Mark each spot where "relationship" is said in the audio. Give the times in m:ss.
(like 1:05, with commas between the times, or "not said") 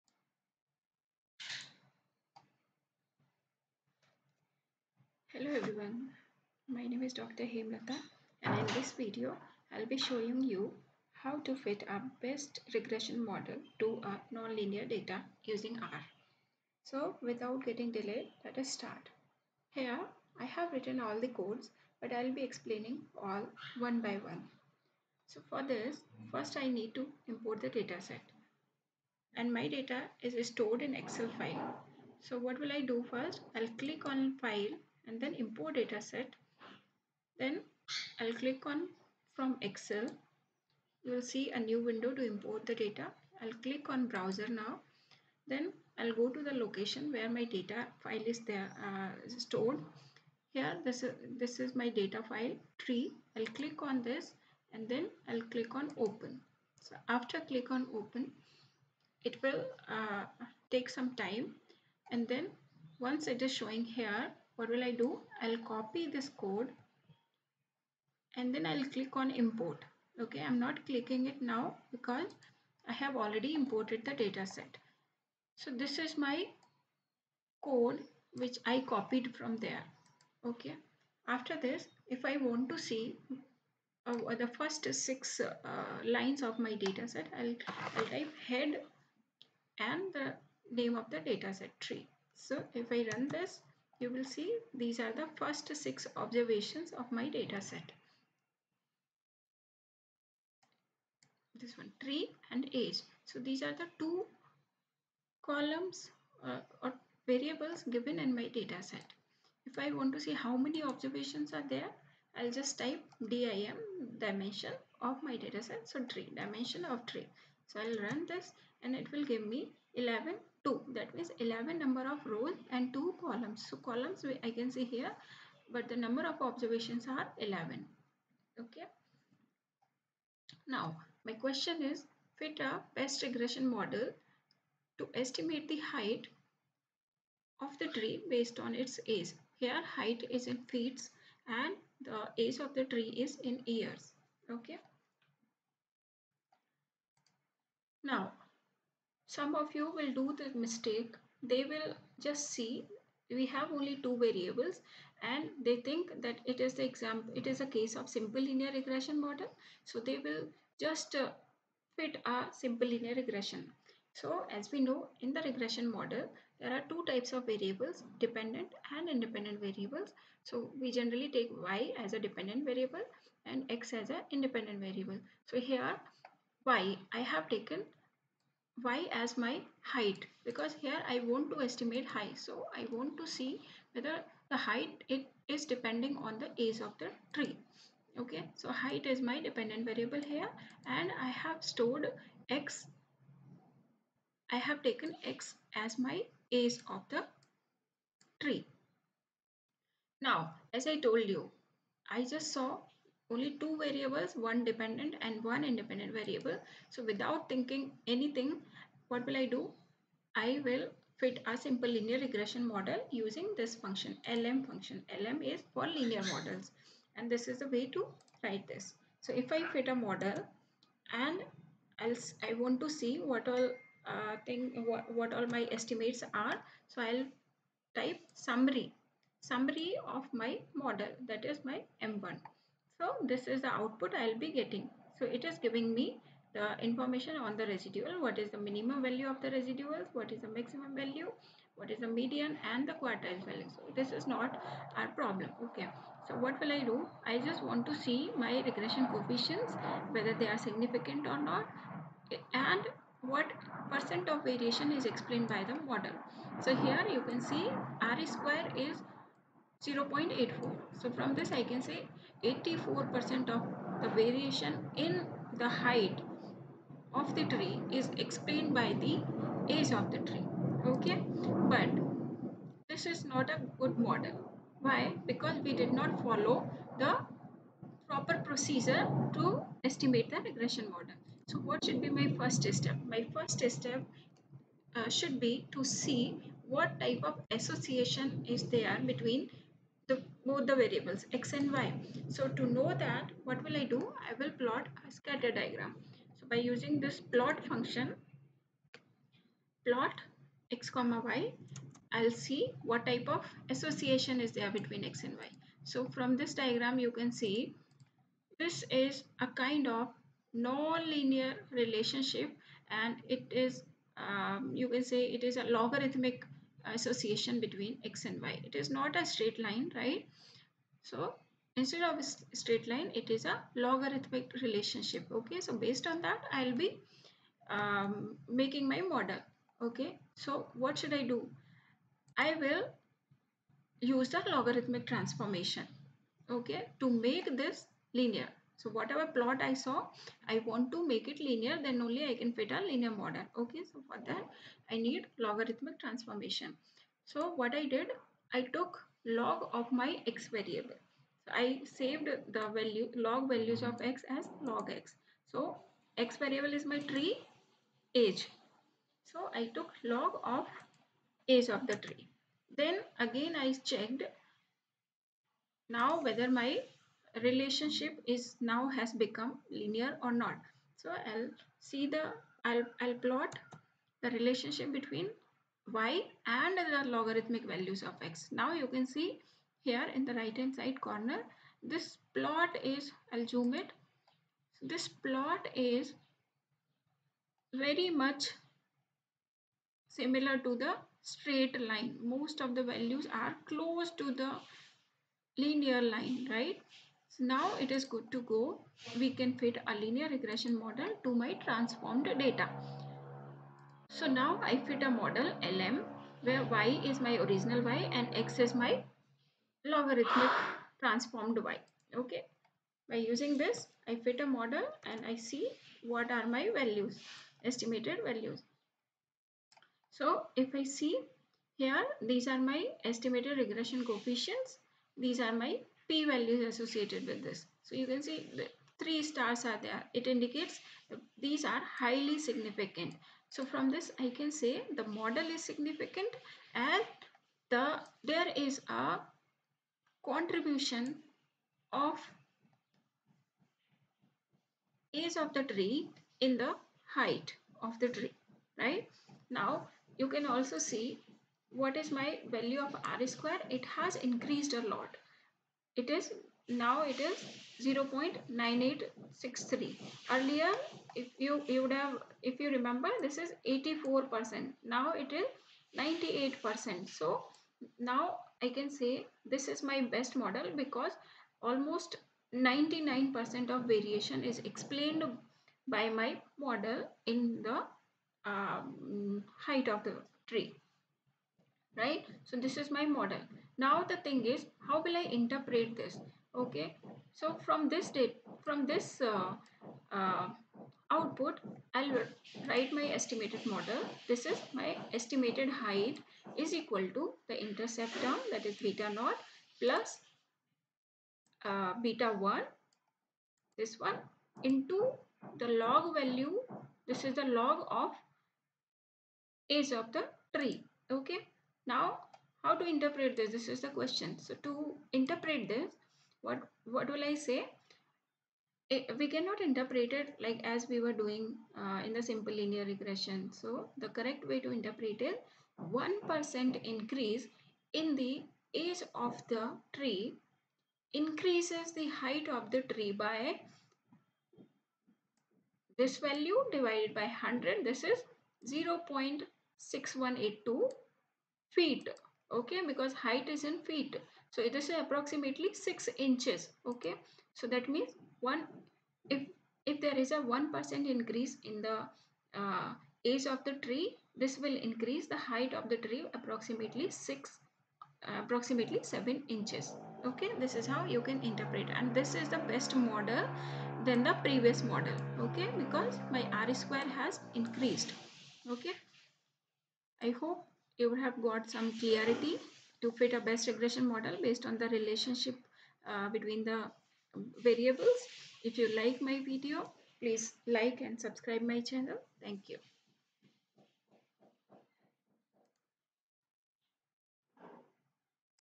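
5:11, 5:24, 6:07, 6:14, 9:34.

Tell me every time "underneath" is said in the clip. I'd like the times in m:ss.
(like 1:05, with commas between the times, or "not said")
not said.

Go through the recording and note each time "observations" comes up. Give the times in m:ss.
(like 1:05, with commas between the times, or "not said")
1:36, 1:50, 2:06.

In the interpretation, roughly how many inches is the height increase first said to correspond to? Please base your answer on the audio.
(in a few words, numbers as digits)
6.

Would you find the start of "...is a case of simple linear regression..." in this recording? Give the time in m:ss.
2:37.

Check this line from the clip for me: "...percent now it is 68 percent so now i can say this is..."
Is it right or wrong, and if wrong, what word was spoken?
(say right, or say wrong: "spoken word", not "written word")
wrong: "98", not "68".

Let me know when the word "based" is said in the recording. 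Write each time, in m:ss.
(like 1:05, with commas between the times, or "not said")
2:18, 5:25, 9:34.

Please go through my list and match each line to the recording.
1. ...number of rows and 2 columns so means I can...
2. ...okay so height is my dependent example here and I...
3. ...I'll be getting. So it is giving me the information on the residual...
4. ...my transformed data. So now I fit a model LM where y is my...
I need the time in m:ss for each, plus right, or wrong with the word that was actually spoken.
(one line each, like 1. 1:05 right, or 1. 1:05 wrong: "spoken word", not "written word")
1. 2:01 wrong: "columns", not "means"
2. 3:08 wrong: "variable", not "example"
3. 3:54 right
4. 6:41 right.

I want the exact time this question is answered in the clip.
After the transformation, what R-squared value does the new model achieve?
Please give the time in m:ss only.
7:37.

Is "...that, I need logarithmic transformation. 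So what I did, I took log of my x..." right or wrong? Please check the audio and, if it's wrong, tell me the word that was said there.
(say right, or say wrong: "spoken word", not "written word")
right.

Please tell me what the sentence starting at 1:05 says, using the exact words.
I'll copy this code and then I'll click on import.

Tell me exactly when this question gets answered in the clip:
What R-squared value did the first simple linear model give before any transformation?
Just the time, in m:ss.
4:19.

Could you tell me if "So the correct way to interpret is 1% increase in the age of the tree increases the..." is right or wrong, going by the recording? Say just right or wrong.
right.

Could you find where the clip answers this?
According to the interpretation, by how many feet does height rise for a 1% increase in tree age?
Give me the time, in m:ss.
8:59.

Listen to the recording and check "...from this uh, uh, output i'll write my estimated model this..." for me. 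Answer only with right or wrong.
right.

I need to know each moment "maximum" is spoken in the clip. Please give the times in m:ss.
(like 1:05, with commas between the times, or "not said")
4:00.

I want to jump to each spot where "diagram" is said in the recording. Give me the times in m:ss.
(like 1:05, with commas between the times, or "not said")
4:55, 5:06.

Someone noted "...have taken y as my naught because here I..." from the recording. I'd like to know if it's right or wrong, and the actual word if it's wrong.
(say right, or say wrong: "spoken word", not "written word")
wrong: "height", not "naught".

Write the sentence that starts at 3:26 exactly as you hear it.
So without thinking anything, what will I do?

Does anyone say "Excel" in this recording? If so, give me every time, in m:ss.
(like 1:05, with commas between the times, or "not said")
0:30, 0:39.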